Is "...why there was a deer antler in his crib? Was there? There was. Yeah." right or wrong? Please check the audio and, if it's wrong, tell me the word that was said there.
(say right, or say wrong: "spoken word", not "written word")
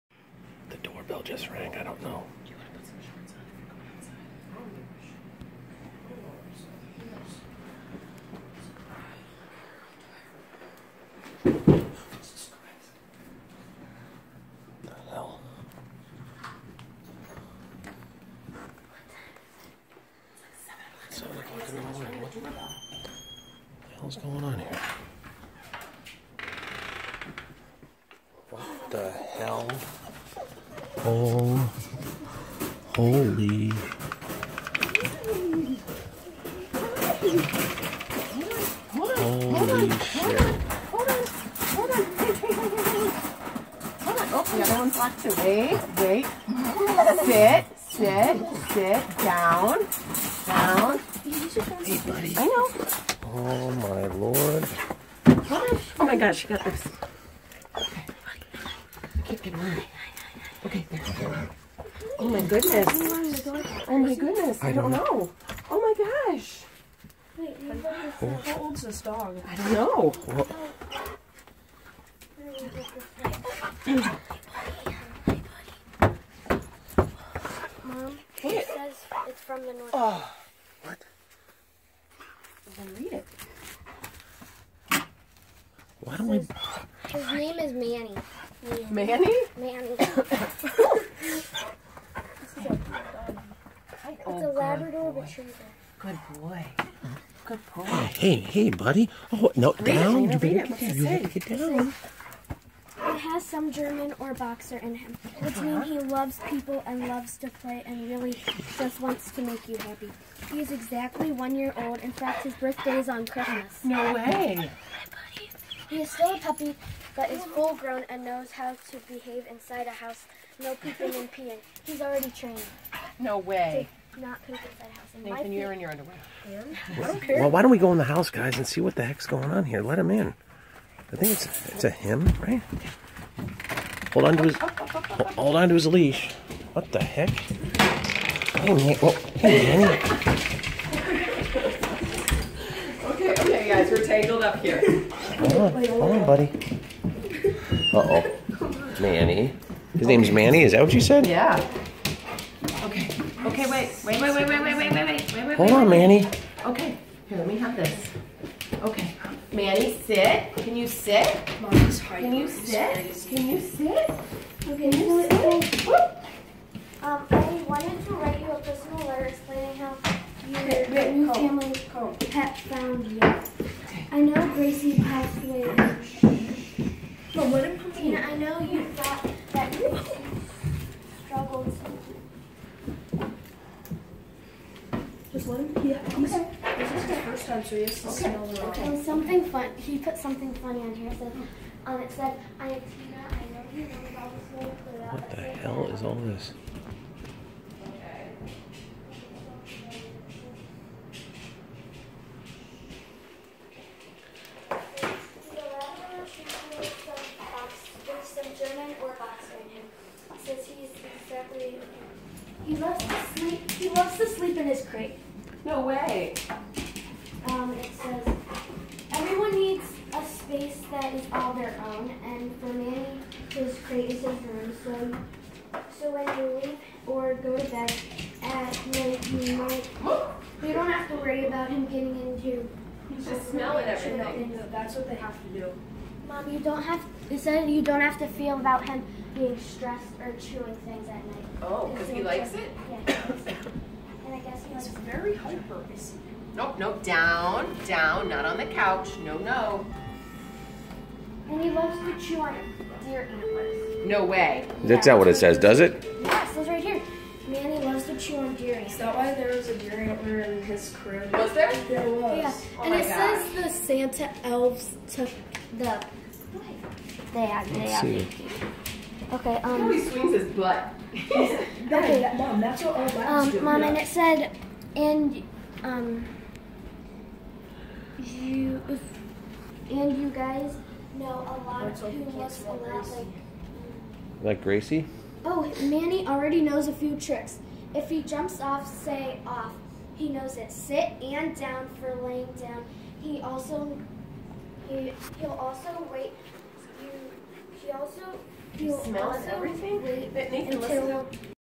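right.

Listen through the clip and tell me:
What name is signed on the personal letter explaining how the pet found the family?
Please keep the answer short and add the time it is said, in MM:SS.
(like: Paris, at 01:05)
Tina, at 03:12.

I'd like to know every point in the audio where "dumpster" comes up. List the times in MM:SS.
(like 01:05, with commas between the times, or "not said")
not said.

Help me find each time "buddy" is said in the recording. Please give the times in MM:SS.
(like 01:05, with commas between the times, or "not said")
00:52, 01:38, 02:26.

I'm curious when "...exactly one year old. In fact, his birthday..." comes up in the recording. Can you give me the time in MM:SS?
01:50.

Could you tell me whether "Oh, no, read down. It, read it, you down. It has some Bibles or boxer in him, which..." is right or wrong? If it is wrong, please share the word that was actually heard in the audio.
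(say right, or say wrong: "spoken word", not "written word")
wrong: "German", not "Bibles".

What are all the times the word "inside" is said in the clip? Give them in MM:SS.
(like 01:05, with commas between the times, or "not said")
01:59, 02:04.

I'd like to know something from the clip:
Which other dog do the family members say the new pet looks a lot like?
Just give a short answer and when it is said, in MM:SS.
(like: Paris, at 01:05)
Gracie, at 04:44.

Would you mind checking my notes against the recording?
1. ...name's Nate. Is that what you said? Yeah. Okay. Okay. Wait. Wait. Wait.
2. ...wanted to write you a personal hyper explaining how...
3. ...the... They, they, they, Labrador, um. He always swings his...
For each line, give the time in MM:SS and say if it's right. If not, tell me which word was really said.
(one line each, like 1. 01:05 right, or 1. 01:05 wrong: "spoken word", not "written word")
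1. 02:30 wrong: "Manny", not "Nate"
2. 02:47 wrong: "letter", not "hyper"
3. 04:25 wrong: "Okay", not "Labrador".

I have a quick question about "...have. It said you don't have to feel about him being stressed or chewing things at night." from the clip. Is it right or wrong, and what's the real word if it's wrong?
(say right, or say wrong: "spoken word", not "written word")
right.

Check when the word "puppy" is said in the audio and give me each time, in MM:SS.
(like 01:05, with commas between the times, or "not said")
01:56.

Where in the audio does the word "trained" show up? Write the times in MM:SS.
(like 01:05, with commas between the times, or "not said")
02:02.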